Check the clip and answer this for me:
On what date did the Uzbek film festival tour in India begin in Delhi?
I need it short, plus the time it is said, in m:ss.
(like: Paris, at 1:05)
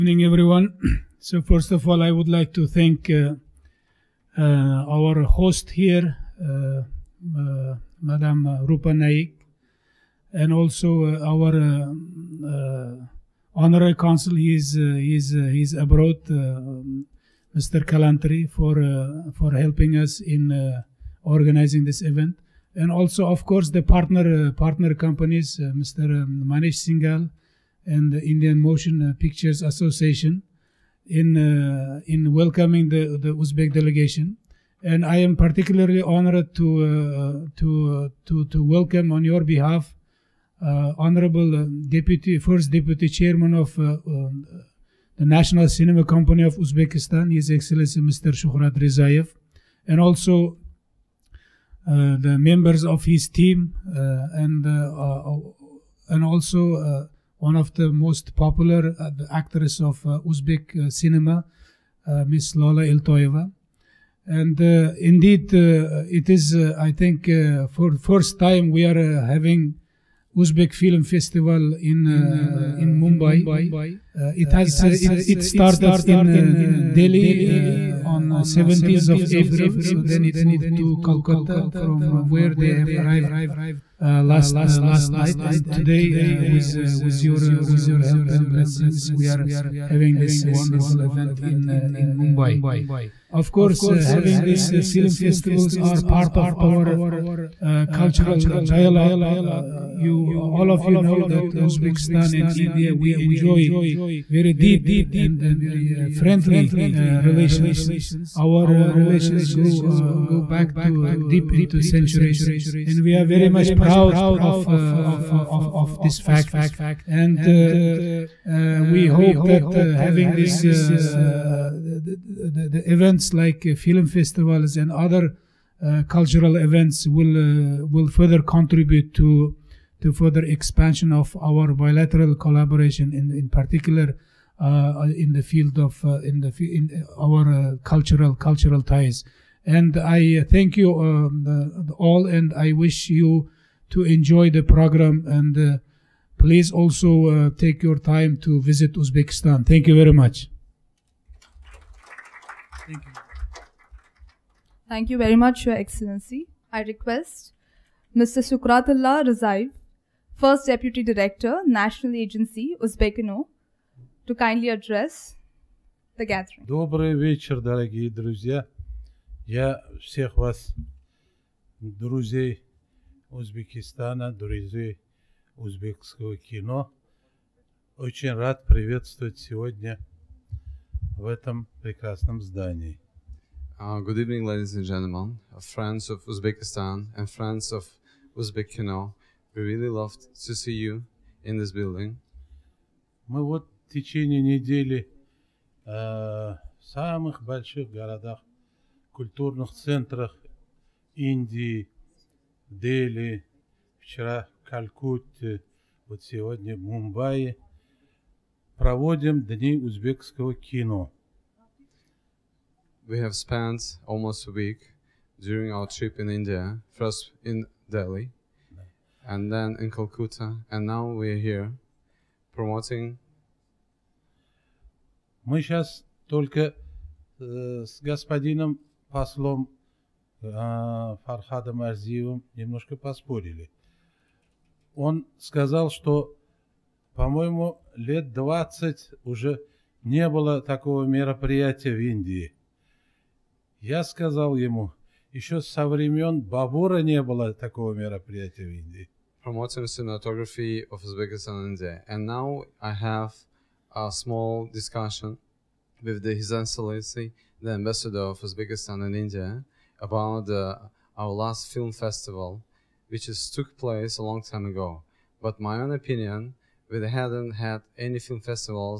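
17th of April, at 1:18.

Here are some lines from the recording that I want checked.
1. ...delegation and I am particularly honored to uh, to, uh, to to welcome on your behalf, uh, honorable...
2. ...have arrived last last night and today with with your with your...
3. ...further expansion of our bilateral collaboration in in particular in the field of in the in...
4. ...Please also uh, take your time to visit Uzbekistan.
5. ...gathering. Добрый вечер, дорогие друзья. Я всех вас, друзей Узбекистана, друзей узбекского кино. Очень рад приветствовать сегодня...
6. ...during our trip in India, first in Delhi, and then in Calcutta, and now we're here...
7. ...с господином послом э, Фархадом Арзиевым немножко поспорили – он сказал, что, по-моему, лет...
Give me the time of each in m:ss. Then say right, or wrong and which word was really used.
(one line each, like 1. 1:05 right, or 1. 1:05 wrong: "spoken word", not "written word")
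1. 0:33 right
2. 1:22 right
3. 2:10 right
4. 2:26 right
5. 2:46 right
6. 3:35 right
7. 3:47 right.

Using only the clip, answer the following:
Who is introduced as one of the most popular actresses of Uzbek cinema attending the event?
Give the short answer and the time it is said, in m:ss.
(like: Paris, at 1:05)
Lola Iltoyeva, at 1:02.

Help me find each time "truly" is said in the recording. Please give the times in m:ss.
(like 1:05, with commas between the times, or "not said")
not said.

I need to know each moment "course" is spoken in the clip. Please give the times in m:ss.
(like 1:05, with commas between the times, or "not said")
0:23, 1:33.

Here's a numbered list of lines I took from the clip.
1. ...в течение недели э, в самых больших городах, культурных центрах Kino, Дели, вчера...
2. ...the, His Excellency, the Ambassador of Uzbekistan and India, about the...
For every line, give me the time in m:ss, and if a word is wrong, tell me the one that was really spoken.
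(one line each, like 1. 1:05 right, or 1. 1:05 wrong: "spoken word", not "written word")
1. 3:13 wrong: "Индии", not "Kino"
2. 4:16 right.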